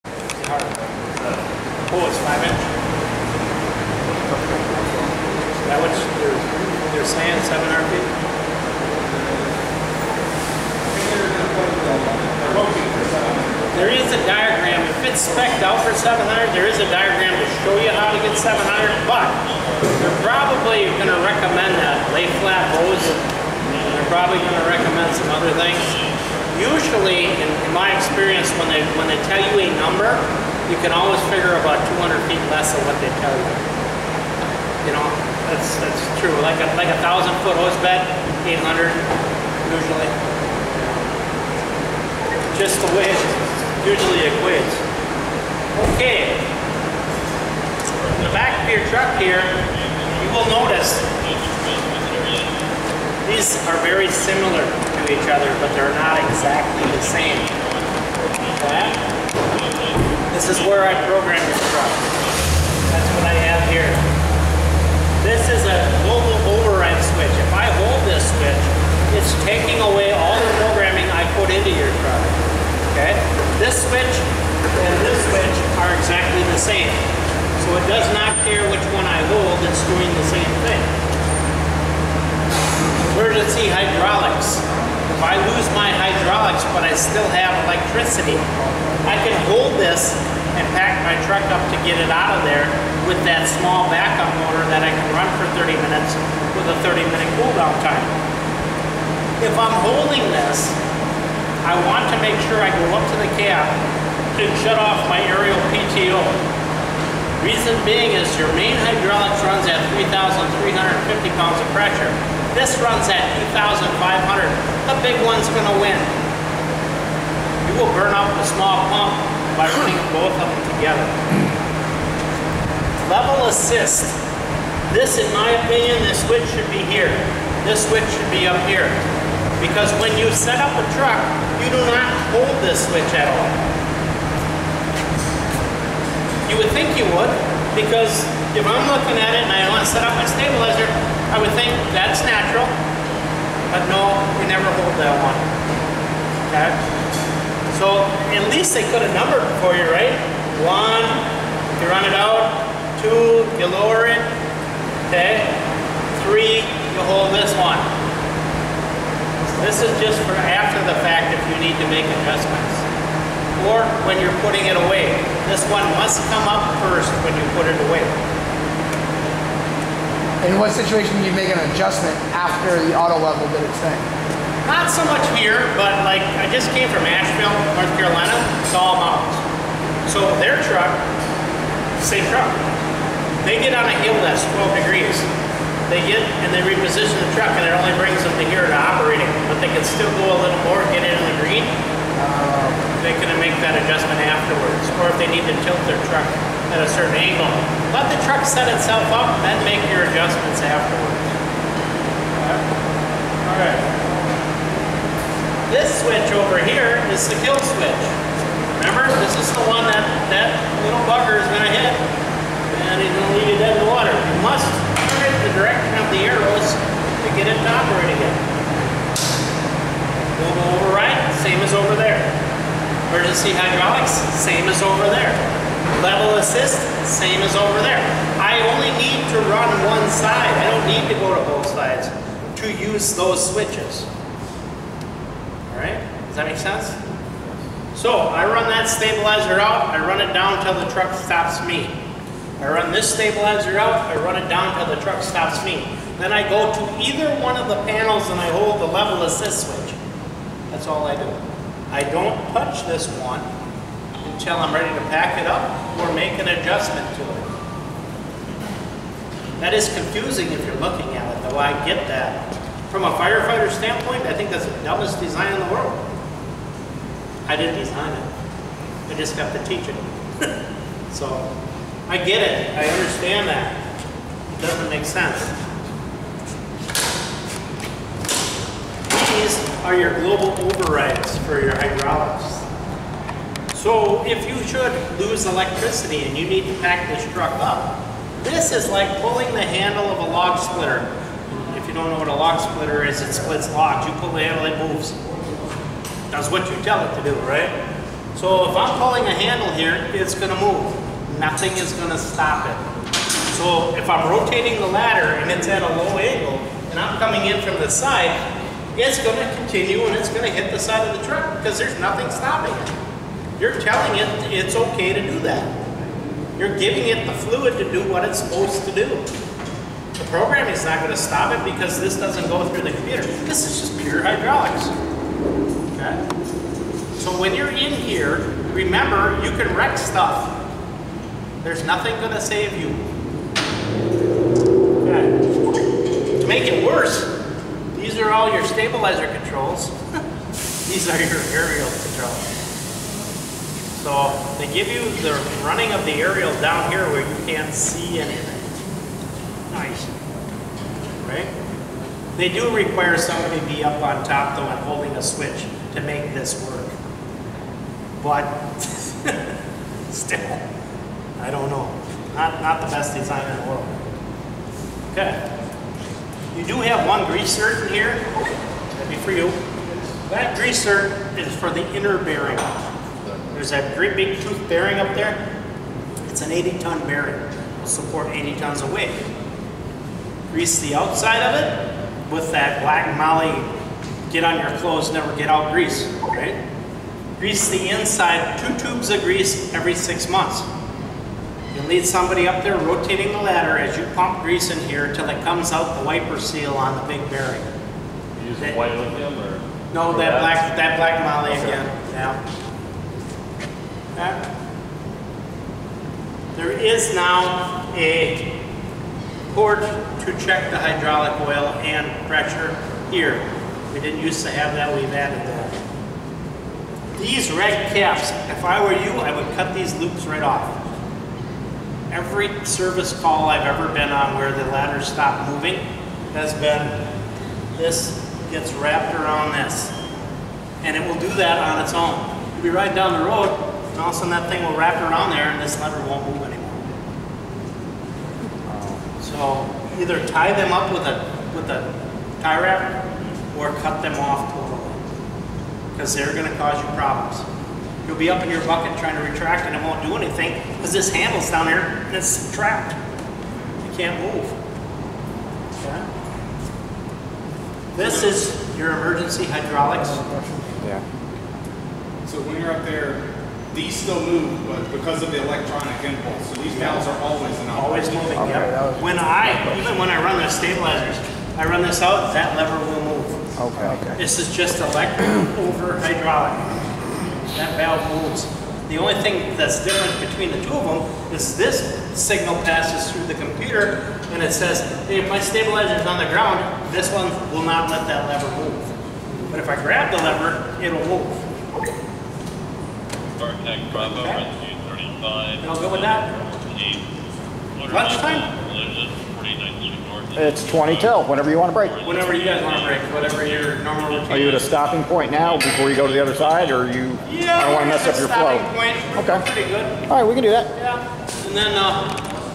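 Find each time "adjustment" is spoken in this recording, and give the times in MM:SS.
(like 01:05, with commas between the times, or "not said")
02:42, 02:51, 03:13, 03:20, 04:16.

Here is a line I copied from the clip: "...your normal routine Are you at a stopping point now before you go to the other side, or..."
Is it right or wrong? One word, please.
right.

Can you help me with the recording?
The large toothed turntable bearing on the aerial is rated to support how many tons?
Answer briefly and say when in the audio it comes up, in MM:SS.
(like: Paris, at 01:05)
80 tons, at 06:16.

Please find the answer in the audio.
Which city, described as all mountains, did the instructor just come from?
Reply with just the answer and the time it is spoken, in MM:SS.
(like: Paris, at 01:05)
Asheville, North Carolina, at 02:57.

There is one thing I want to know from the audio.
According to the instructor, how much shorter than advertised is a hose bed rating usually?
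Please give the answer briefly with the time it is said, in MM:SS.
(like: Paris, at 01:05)
200 feet, at 00:31.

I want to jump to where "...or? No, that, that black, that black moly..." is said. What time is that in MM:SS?
06:39.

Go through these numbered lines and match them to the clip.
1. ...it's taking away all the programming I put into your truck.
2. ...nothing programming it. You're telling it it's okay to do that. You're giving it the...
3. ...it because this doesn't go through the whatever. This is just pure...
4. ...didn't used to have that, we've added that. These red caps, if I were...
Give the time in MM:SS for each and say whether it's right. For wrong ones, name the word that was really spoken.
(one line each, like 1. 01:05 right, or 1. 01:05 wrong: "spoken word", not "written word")
1. 01:09 right
2. 05:11 wrong: "stopping", not "programming"
3. 05:21 wrong: "computer", not "whatever"
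4. 06:53 right.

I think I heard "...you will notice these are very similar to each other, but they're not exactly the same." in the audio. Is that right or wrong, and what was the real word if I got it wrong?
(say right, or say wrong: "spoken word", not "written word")
right.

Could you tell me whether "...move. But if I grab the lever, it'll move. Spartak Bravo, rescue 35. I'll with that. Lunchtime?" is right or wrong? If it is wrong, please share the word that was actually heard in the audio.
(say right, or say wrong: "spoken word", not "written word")
right.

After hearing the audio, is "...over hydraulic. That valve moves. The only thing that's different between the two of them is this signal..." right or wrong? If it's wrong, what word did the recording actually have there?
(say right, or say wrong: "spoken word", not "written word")
right.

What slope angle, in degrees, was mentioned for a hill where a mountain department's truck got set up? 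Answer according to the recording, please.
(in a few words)
12 degrees.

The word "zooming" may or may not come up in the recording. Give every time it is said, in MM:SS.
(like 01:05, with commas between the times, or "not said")
not said.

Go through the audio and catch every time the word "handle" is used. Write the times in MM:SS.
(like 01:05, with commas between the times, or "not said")
04:49, 04:54, 04:59, 07:31.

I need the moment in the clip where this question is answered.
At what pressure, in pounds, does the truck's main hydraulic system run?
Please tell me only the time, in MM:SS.
01:49.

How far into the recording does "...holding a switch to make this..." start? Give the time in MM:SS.
05:54.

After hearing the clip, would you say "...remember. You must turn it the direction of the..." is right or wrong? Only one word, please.
wrong.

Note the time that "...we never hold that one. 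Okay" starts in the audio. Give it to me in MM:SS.
02:24.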